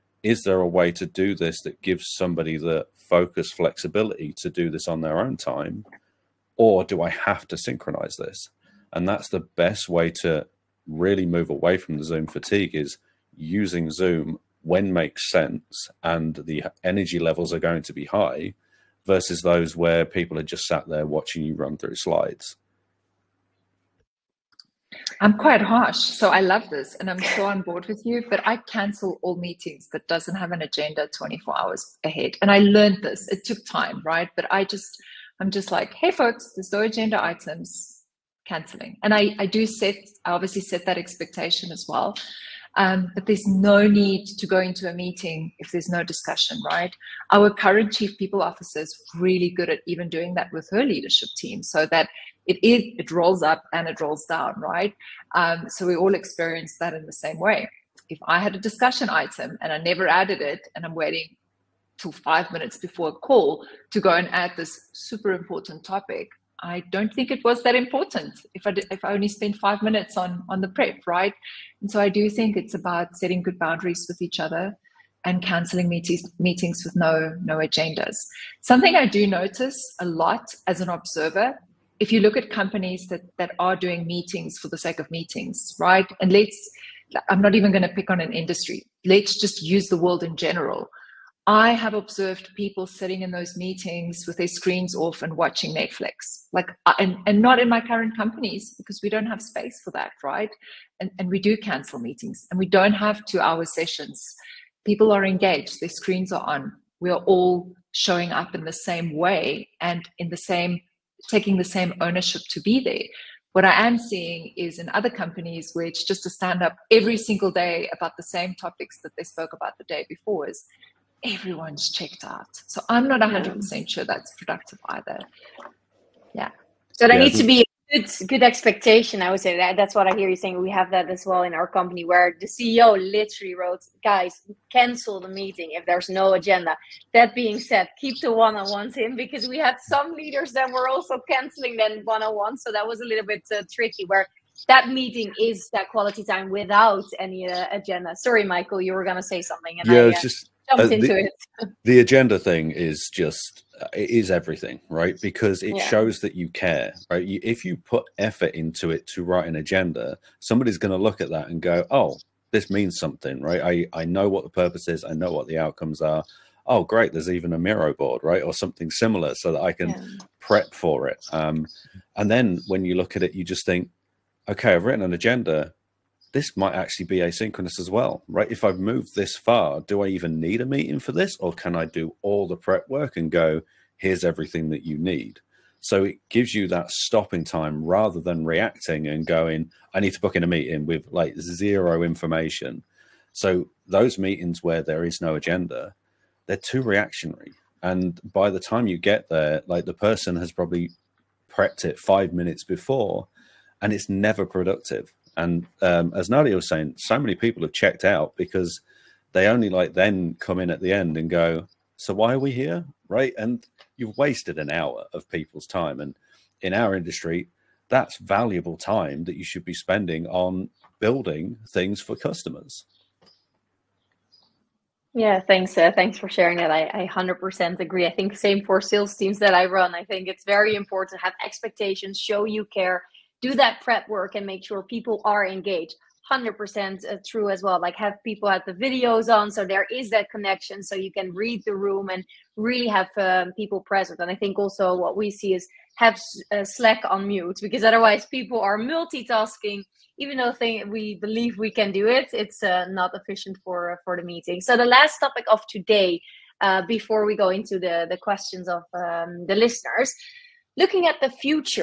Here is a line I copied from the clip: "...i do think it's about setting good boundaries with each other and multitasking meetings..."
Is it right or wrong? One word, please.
wrong.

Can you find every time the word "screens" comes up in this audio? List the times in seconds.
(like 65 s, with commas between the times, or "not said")
94 s, 105 s.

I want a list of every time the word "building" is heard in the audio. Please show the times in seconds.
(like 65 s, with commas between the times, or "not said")
220 s.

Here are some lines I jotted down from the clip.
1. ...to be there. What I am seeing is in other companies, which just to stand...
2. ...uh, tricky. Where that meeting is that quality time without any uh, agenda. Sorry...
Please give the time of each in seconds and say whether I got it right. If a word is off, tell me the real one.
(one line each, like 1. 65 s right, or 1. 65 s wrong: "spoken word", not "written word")
1. 112 s right
2. 143 s right.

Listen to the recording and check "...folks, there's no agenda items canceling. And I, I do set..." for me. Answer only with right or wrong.
right.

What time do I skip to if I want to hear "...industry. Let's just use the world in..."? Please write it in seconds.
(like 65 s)
88 s.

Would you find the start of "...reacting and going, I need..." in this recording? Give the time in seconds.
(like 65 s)
188 s.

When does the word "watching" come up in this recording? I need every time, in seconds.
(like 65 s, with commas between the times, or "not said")
21 s, 95 s.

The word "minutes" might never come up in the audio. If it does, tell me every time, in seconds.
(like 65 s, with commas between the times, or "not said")
62 s, 69 s, 202 s.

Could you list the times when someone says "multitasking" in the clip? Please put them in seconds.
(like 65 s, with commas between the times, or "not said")
248 s.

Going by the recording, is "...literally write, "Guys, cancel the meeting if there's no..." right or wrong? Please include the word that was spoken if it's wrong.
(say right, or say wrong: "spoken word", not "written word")
wrong: "wrote", not "write".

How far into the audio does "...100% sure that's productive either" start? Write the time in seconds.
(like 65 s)
123 s.